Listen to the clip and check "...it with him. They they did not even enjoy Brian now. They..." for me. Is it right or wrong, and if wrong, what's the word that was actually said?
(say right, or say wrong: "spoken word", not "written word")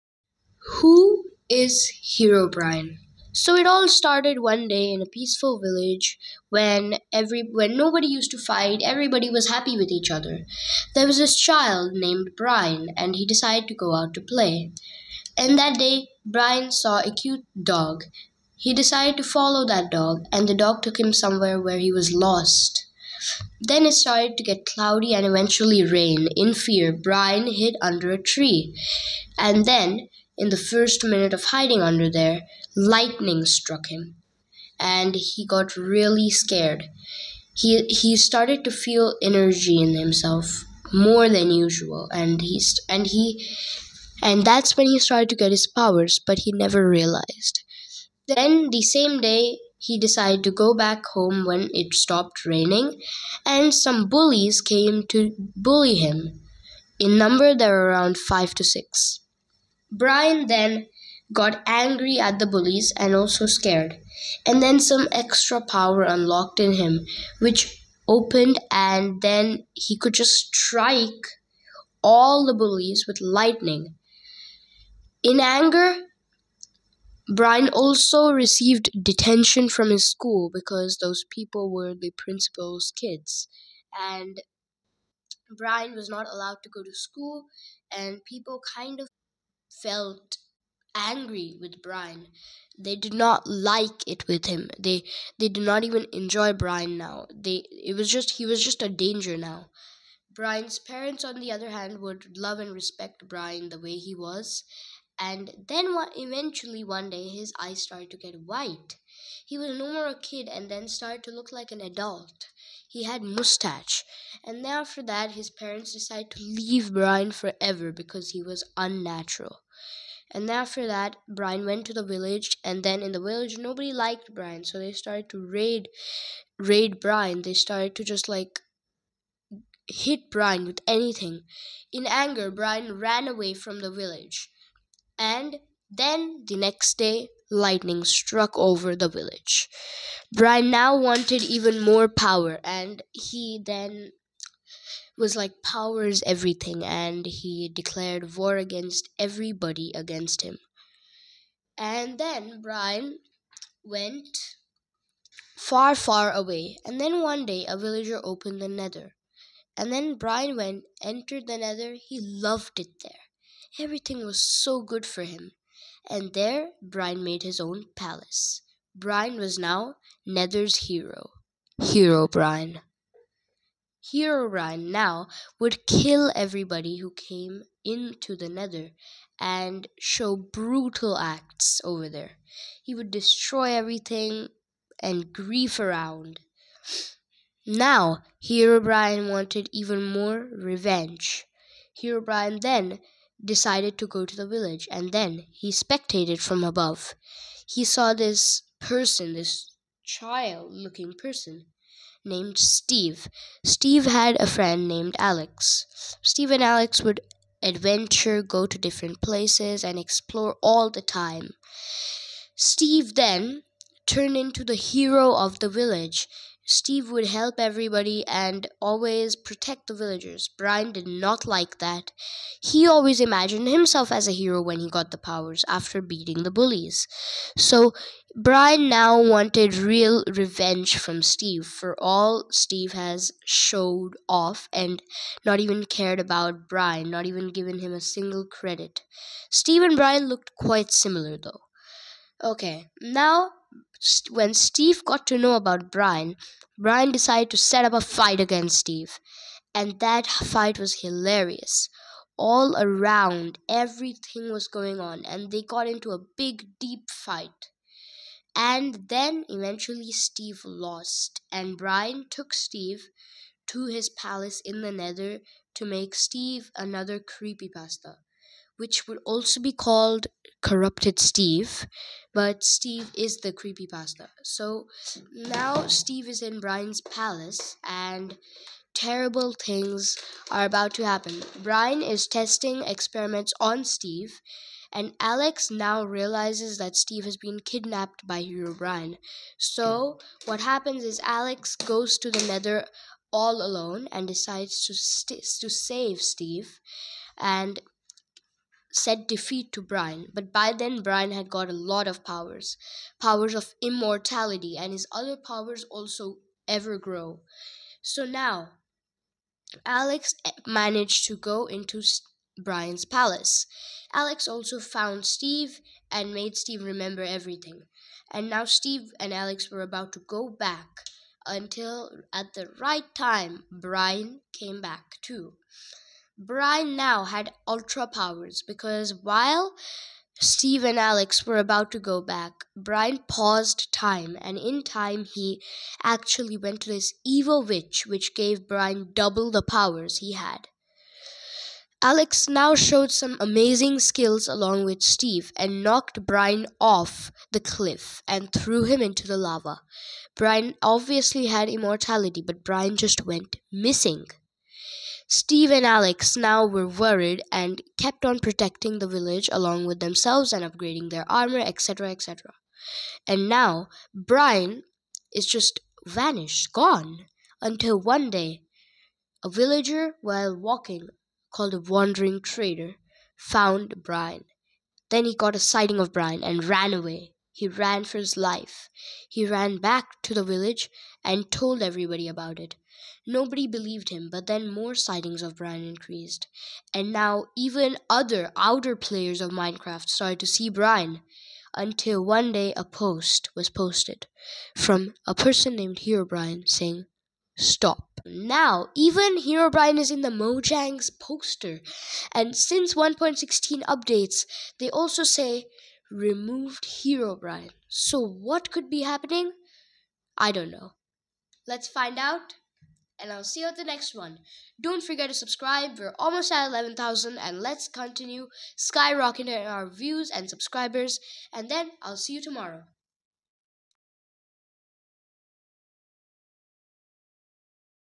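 right.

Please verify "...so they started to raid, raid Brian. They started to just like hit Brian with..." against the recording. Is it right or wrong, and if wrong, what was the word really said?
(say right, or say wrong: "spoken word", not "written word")
right.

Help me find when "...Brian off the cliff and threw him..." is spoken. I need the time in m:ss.
5:46.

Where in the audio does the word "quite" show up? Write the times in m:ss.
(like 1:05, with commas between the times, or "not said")
4:00.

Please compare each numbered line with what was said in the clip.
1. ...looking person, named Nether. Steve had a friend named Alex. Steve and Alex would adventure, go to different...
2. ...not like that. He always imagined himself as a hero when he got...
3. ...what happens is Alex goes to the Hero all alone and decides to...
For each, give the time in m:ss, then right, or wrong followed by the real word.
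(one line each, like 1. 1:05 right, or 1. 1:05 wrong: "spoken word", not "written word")
1. 3:20 wrong: "Steve", not "Nether"
2. 3:41 right
3. 4:50 wrong: "Nether", not "Hero".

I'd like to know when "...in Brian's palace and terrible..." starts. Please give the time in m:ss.
4:36.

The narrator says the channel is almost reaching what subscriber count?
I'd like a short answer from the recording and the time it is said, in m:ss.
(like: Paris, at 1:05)
11,000, at 6:56.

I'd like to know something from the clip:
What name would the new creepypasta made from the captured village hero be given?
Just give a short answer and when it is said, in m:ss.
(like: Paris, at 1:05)
Corrupted Steve, at 4:30.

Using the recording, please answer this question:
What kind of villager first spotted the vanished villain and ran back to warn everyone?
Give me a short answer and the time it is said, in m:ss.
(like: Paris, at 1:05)
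Wandering trader, at 6:11.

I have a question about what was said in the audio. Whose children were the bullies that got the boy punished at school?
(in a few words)
The principal's.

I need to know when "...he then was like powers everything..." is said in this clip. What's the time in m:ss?
2:23.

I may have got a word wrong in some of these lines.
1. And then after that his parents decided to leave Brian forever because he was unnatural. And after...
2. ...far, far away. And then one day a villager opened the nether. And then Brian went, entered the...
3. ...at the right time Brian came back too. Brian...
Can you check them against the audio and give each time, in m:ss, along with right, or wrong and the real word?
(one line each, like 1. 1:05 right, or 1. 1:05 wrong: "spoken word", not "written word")
1. 1:54 right
2. 2:35 right
3. 5:22 right.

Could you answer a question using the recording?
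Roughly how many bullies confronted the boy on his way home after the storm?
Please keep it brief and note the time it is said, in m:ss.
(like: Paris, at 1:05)
5 to 6, at 0:58.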